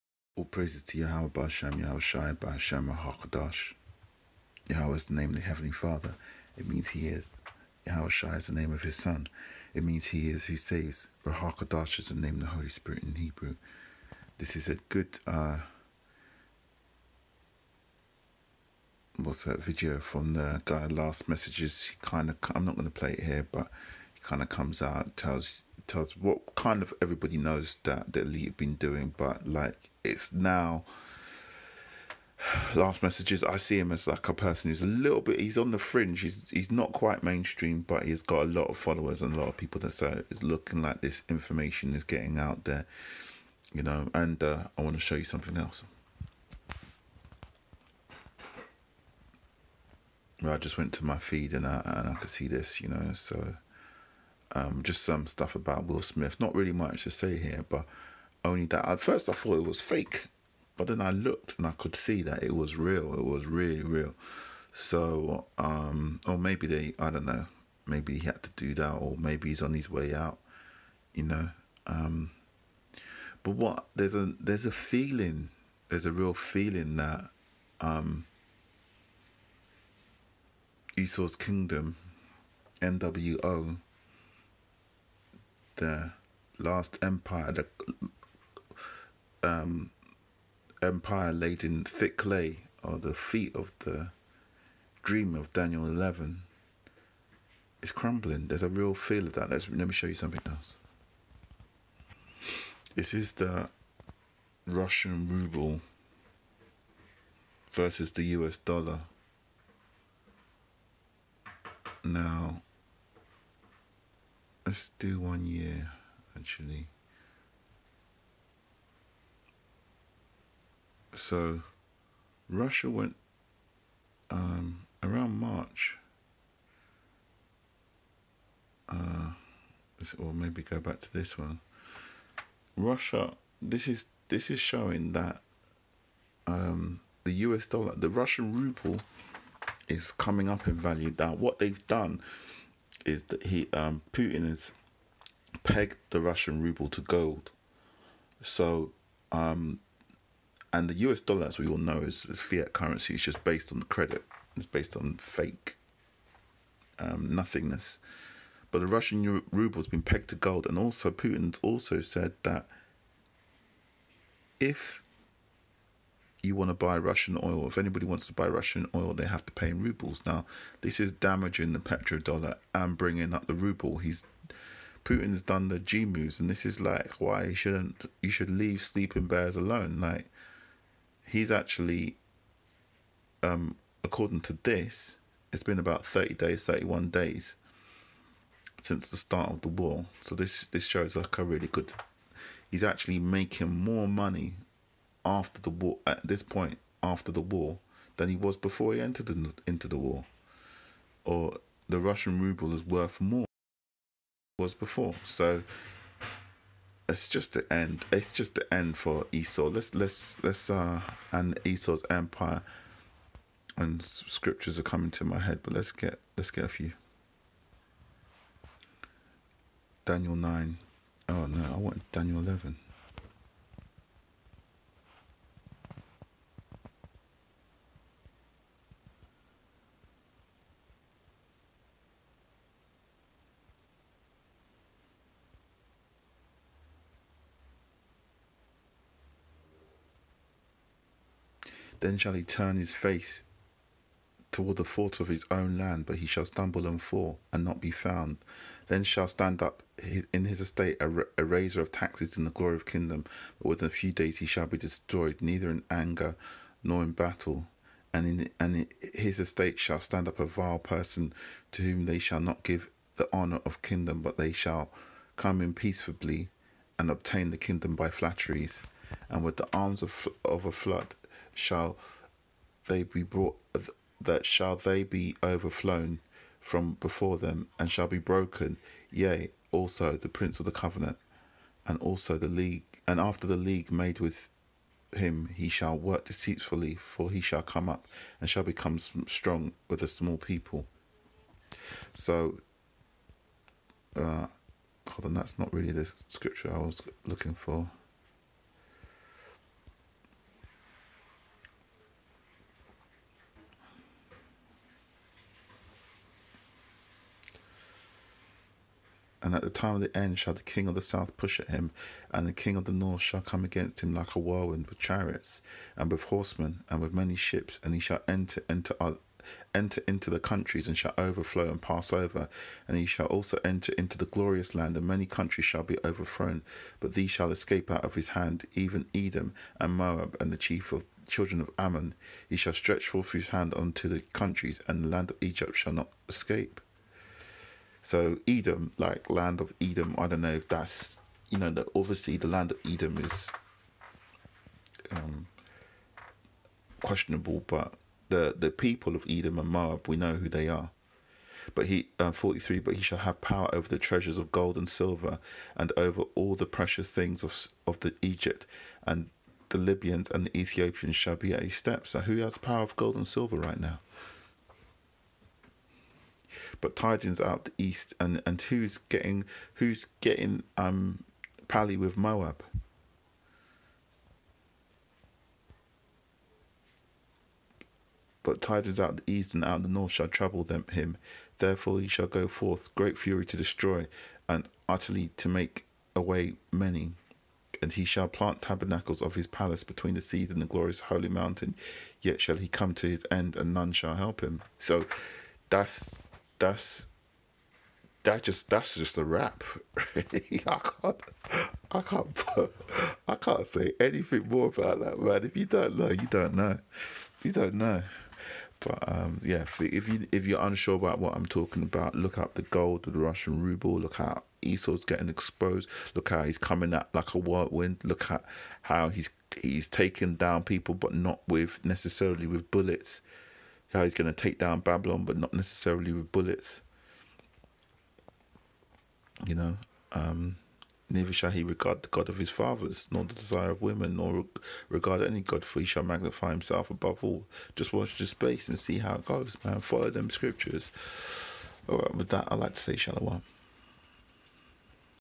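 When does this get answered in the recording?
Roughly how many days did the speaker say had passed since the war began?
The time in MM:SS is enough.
03:06.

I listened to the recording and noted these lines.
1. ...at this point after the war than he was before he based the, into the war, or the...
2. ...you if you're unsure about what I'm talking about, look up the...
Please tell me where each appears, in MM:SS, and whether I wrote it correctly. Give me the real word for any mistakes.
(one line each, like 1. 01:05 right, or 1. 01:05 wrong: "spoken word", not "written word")
1. 03:16 wrong: "entered", not "based"
2. 06:50 right.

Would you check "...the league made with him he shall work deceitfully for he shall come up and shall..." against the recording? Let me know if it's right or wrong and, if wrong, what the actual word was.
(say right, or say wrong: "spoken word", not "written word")
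right.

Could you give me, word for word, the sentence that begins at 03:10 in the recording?
So this this shows like a really good.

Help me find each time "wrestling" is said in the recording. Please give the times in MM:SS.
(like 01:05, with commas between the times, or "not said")
not said.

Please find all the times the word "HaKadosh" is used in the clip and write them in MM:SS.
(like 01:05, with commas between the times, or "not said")
00:02, 00:11.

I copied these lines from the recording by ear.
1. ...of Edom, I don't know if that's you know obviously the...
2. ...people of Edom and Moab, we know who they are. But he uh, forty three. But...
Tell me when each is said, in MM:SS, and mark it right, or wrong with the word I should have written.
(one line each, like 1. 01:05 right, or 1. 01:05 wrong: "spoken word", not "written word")
1. 05:39 right
2. 05:48 right.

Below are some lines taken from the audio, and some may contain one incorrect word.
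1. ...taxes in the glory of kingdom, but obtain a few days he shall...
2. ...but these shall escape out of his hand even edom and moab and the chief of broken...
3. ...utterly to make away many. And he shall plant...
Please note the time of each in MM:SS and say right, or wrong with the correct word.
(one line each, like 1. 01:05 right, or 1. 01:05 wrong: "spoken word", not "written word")
1. 04:11 wrong: "within", not "obtain"
2. 05:26 wrong: "children", not "broken"
3. 06:24 right.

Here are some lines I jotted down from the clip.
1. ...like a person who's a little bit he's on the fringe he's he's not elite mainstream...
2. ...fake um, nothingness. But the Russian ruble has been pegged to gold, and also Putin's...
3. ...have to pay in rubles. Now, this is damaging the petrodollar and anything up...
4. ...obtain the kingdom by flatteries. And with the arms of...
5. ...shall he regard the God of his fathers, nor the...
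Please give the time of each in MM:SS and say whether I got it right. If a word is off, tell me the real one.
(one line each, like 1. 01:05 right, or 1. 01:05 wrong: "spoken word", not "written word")
1. 00:34 wrong: "quite", not "elite"
2. 02:35 right
3. 02:49 wrong: "bringing", not "anything"
4. 04:27 right
5. 07:11 right.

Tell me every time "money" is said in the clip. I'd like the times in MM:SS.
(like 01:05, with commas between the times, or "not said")
03:14.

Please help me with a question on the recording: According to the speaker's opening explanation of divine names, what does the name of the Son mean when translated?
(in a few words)
He is who saves.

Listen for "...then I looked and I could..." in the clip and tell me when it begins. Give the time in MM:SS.
01:00.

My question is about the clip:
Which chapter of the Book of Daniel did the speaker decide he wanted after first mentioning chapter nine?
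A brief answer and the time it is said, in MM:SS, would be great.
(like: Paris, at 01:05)
Daniel 11, at 03:42.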